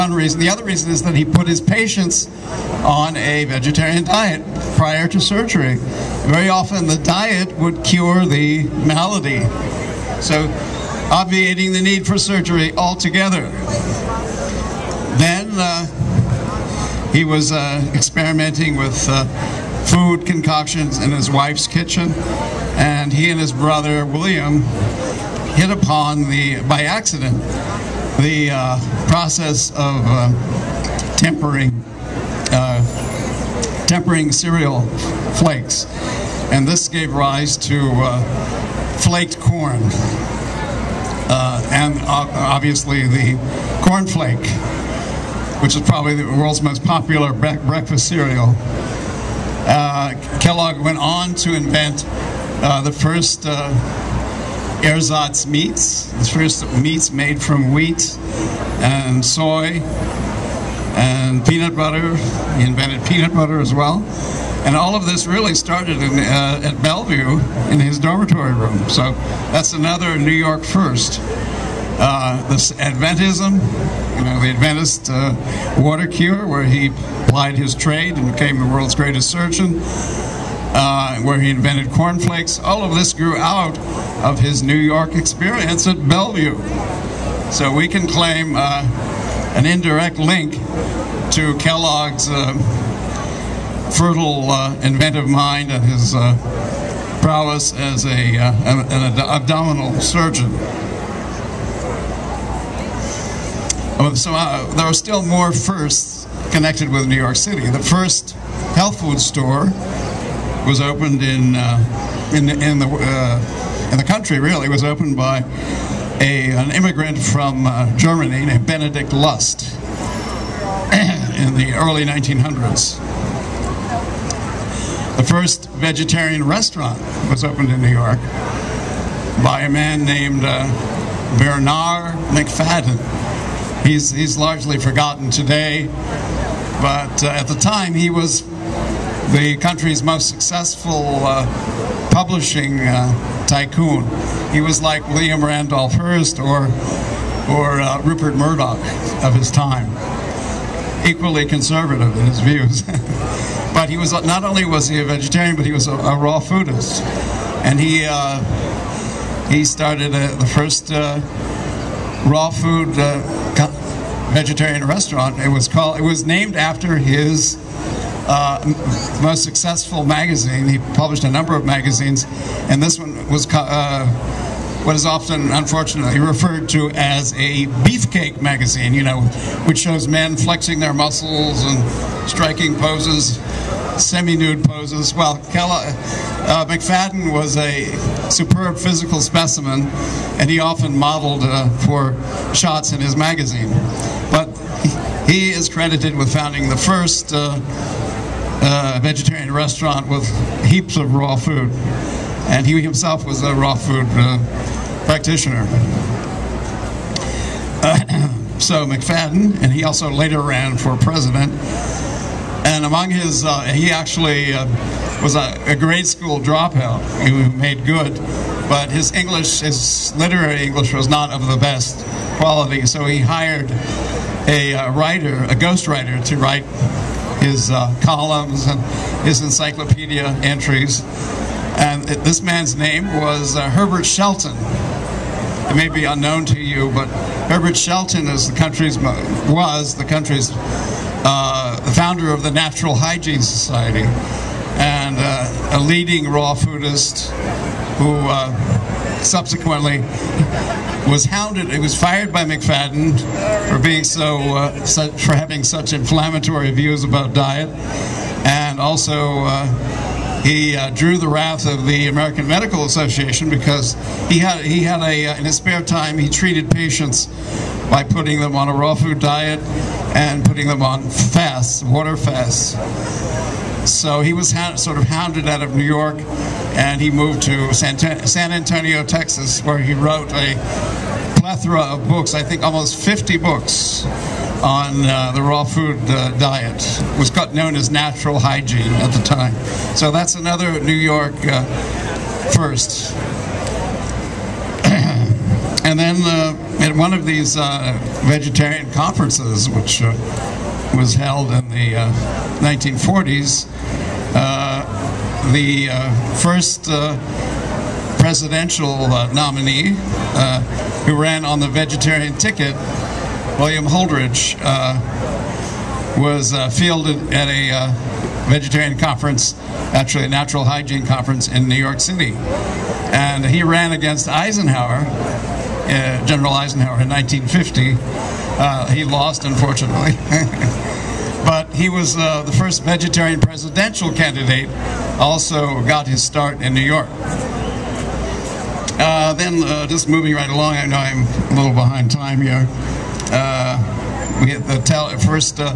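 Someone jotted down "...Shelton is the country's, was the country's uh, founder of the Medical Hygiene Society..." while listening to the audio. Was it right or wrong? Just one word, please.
wrong.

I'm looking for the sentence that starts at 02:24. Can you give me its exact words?
He was like William Randolph Hearst or, or uh, Rupert Murdoch of his time, equally conservative in his views.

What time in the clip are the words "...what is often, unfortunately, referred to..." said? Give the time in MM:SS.
02:54.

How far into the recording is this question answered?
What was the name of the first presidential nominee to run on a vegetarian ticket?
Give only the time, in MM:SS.
05:13.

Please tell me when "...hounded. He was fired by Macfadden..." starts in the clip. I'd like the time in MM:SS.
04:11.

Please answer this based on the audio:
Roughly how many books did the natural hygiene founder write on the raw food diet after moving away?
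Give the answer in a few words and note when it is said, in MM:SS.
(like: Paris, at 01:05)
50, at 04:42.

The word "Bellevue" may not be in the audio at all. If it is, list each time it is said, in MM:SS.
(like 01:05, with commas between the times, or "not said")
01:06, 01:26.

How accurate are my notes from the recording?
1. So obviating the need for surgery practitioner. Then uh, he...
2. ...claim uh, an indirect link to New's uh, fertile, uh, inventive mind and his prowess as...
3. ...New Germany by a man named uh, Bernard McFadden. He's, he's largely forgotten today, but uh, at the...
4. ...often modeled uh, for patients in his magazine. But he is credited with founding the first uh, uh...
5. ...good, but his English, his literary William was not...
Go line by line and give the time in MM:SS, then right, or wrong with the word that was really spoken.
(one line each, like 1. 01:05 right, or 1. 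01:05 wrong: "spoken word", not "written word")
1. 00:10 wrong: "altogether", not "practitioner"
2. 01:28 wrong: "Kellogg", not "New"
3. 02:07 wrong: "York", not "Germany"
4. 03:10 wrong: "shots", not "patients"
5. 03:37 wrong: "English", not "William".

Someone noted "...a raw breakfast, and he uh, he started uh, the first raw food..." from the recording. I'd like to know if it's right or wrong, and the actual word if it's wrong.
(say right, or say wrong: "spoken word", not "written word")
wrong: "foodist", not "breakfast".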